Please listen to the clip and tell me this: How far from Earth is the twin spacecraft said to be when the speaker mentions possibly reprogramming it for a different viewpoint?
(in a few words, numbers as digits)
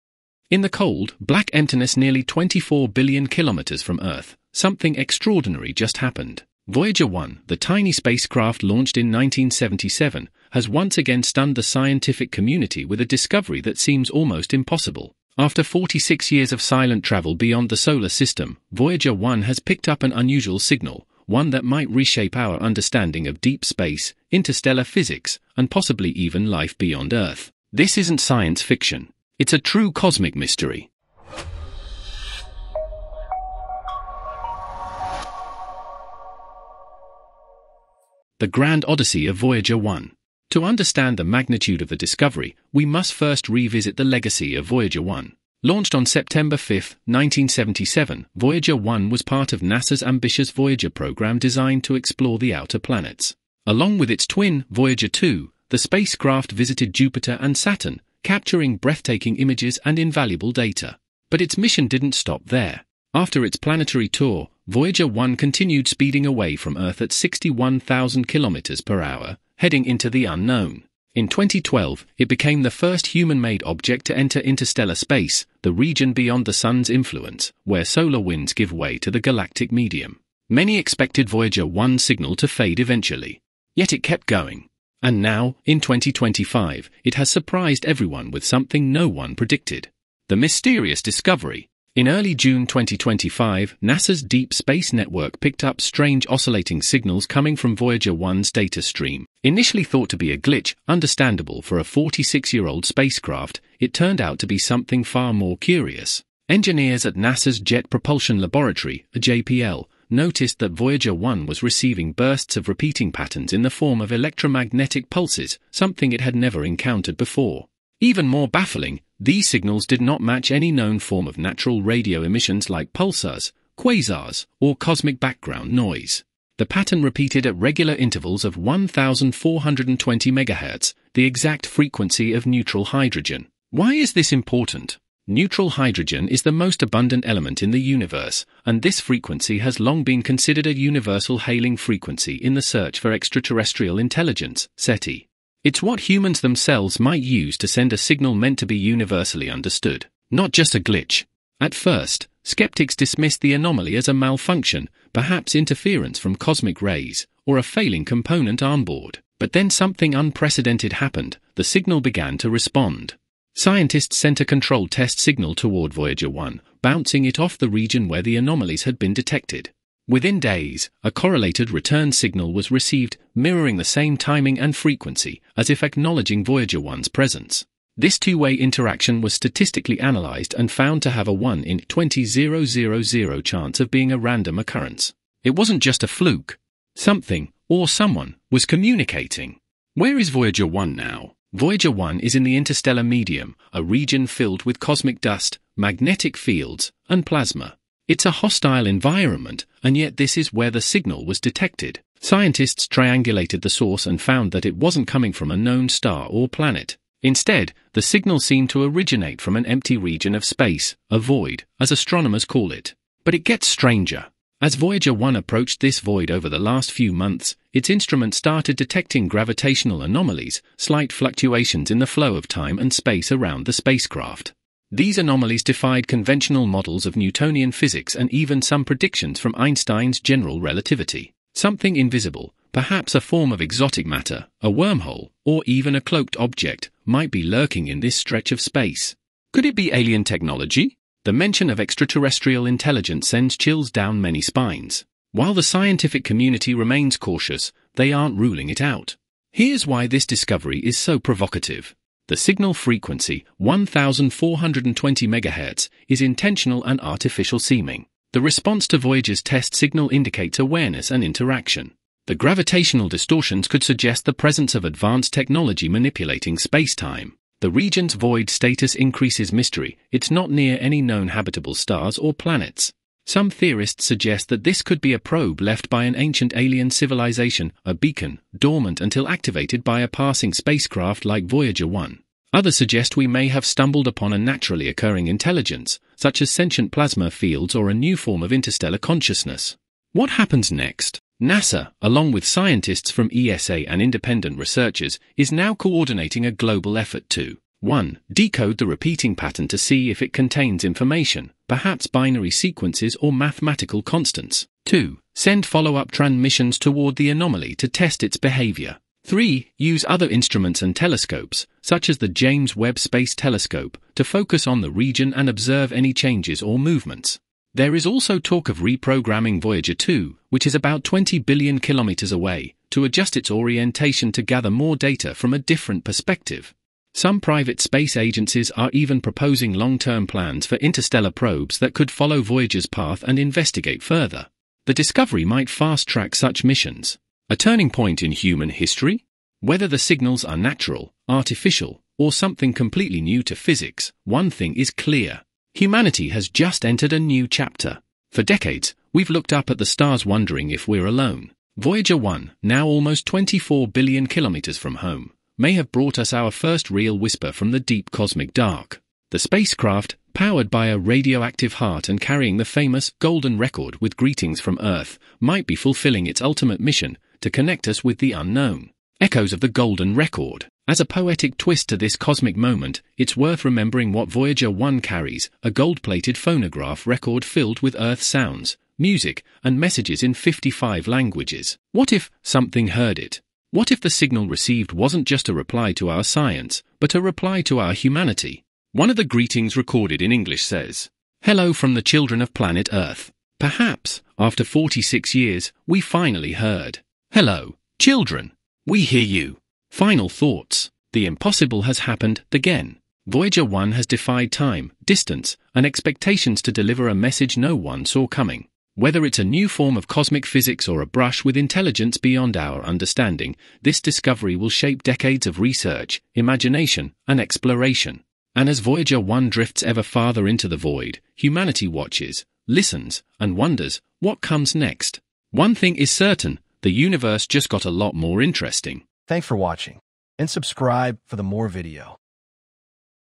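20 billion kilometers.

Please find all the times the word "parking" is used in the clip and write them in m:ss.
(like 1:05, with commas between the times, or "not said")
not said.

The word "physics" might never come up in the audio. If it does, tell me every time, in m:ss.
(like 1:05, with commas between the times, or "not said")
0:24, 3:47, 5:43, 6:50.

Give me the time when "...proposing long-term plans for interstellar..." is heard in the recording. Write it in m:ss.
5:29.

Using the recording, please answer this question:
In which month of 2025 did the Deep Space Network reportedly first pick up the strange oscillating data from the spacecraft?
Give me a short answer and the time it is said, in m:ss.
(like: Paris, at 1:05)
June, at 1:32.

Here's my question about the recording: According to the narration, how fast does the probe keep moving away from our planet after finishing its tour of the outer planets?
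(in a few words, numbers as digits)
61,000 kilometers per hour.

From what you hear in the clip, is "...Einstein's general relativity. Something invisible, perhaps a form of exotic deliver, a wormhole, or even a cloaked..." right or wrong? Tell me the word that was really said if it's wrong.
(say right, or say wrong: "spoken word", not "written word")
wrong: "matter", not "deliver".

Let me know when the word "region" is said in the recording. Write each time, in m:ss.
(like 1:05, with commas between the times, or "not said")
1:15, 2:47, 3:13, 3:29, 4:27, 5:14.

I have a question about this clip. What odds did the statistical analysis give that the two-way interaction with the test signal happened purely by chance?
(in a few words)
1 in 20,000.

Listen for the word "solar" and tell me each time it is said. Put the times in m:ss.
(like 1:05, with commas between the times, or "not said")
0:17, 1:17.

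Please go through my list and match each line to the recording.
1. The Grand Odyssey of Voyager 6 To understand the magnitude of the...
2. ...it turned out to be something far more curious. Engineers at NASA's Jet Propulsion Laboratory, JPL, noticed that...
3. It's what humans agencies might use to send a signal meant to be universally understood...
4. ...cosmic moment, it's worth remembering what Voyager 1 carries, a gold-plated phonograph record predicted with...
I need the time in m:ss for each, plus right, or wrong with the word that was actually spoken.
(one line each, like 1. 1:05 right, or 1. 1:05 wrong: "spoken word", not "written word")
1. 0:38 wrong: "1", not "6"
2. 1:43 right
3. 2:25 wrong: "themselves", not "agencies"
4. 6:12 wrong: "filled", not "predicted".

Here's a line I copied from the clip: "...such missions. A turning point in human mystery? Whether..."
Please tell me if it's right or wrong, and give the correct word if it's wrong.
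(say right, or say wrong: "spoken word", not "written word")
wrong: "history", not "mystery".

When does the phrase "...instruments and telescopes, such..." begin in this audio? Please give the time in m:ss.
5:10.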